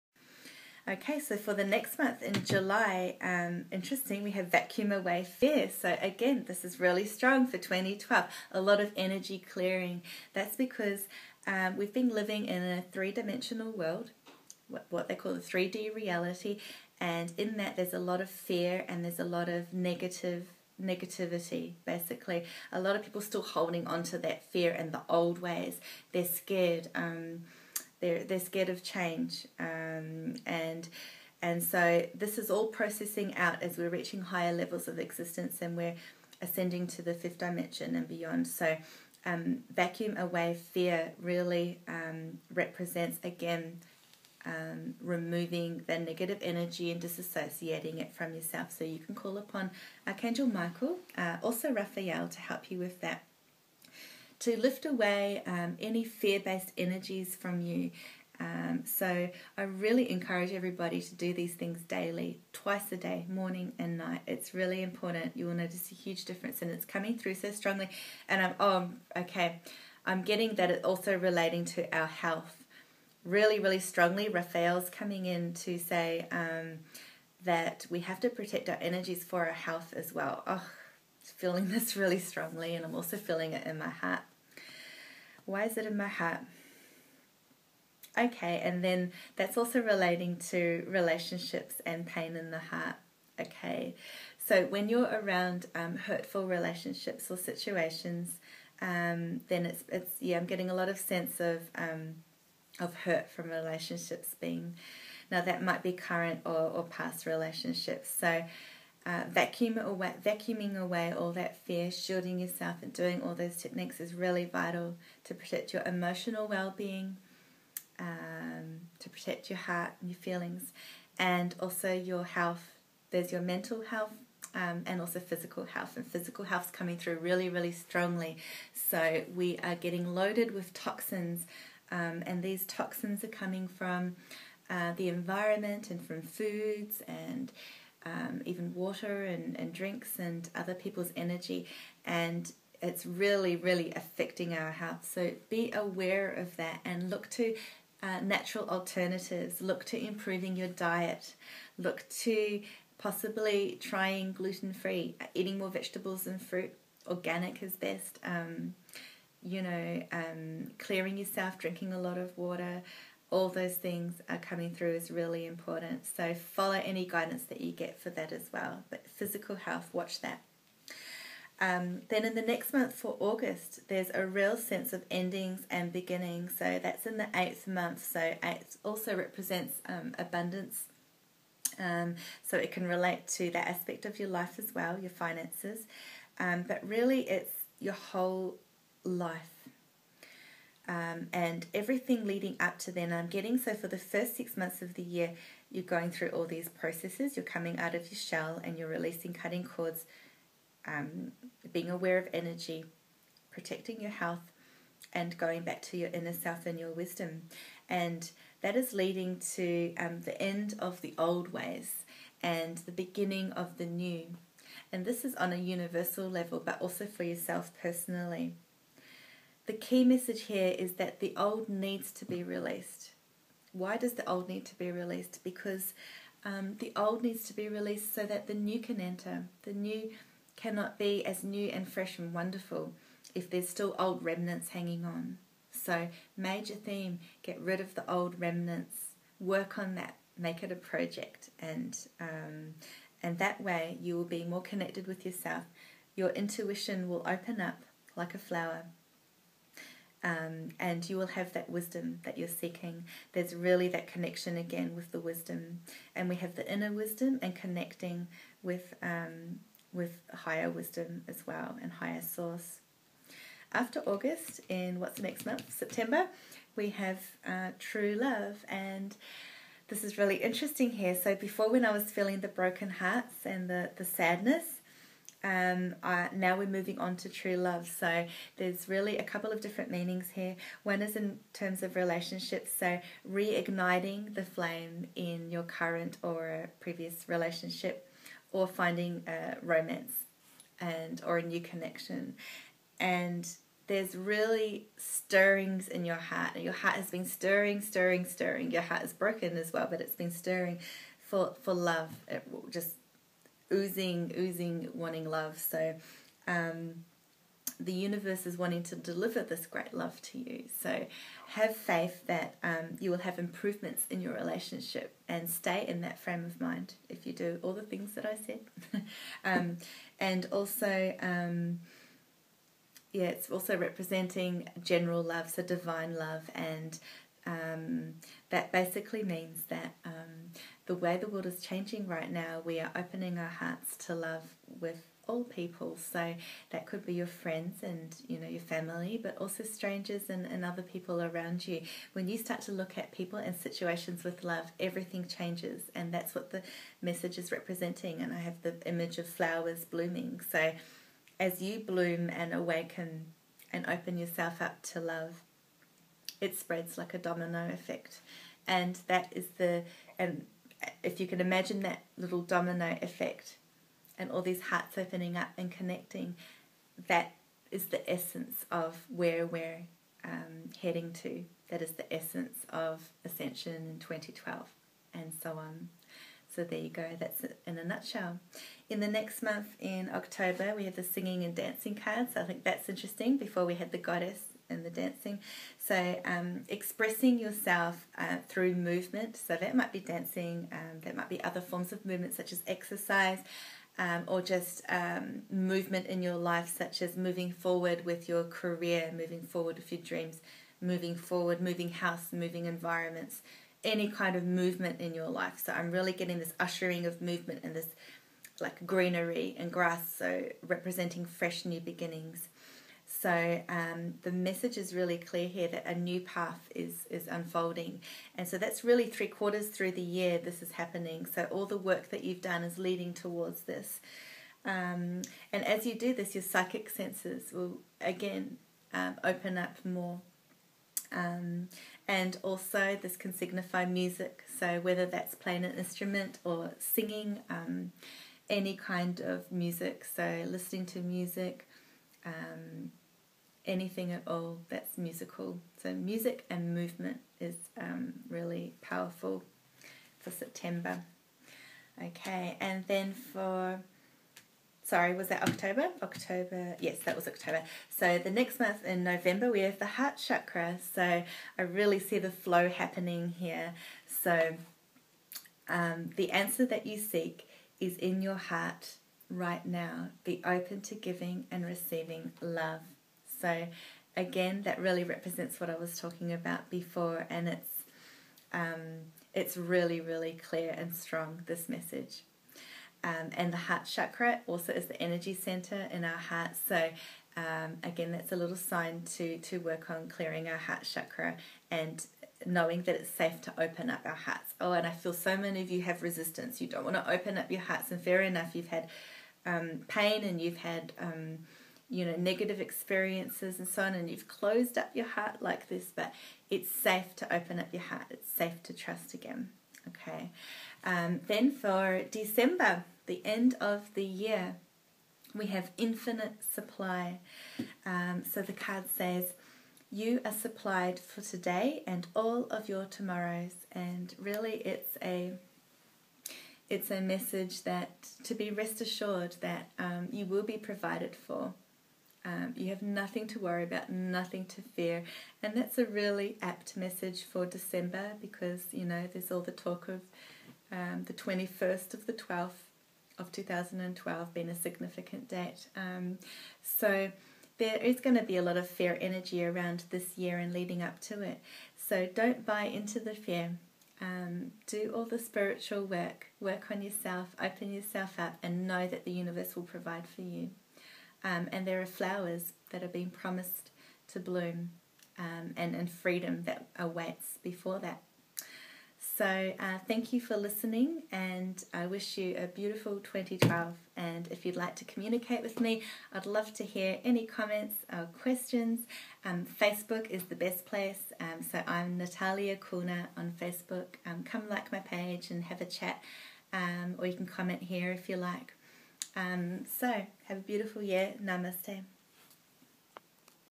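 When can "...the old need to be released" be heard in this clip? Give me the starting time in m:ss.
3:44.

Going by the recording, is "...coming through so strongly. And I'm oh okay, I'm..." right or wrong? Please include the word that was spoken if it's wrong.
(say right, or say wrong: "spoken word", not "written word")
right.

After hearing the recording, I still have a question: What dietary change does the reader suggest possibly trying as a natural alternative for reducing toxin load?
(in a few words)
Gluten free.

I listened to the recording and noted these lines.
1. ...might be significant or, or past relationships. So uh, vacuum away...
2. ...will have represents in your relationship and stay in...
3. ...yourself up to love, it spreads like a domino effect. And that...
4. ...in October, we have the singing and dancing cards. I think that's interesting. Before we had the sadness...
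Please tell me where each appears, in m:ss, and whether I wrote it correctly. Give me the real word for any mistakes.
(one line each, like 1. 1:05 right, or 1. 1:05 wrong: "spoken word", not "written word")
1. 1:45 wrong: "current", not "significant"
2. 5:13 wrong: "improvements", not "represents"
3. 5:54 right
4. 6:19 wrong: "goddess", not "sadness".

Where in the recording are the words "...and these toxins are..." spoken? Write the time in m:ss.
2:12.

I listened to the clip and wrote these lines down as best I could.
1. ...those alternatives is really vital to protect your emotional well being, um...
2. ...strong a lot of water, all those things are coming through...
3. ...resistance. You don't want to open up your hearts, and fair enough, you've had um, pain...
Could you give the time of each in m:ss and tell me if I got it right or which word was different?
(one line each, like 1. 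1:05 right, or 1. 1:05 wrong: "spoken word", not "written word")
1. 1:53 wrong: "techniques", not "alternatives"
2. 2:41 wrong: "drinking", not "strong"
3. 8:16 right.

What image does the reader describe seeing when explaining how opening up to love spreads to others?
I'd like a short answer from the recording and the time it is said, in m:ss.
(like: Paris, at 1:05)
Flowers blooming, at 5:49.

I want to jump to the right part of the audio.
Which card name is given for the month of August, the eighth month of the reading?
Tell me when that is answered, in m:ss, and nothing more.
2:55.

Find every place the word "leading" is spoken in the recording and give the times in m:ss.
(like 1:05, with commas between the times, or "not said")
3:12, 3:28, 7:02, 9:10.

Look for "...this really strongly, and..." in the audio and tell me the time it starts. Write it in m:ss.
1:21.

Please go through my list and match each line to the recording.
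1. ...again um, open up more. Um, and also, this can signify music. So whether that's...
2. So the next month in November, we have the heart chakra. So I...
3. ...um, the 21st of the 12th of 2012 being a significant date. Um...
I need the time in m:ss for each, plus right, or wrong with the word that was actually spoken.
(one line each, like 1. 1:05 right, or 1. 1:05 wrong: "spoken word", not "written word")
1. 7:08 right
2. 7:37 right
3. 9:00 right.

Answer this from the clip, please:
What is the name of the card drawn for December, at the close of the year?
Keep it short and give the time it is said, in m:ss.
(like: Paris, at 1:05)
Infinite supply, at 8:35.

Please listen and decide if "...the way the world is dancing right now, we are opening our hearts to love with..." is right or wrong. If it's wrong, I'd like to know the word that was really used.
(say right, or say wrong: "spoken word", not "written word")
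wrong: "changing", not "dancing".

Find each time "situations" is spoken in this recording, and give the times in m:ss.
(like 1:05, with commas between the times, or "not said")
1:37, 5:43.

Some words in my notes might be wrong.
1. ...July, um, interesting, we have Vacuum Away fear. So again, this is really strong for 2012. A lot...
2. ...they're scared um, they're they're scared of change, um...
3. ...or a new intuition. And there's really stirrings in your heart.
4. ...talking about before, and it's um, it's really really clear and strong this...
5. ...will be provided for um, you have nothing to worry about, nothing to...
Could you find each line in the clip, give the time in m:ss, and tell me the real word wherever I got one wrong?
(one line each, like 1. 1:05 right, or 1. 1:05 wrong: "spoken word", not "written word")
1. 0:02 right
2. 0:26 right
3. 4:51 wrong: "connection", not "intuition"
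4. 7:55 right
5. 8:50 right.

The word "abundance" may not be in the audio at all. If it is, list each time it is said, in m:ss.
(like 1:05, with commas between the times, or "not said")
3:00.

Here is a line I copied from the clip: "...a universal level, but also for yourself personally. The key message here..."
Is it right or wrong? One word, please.
right.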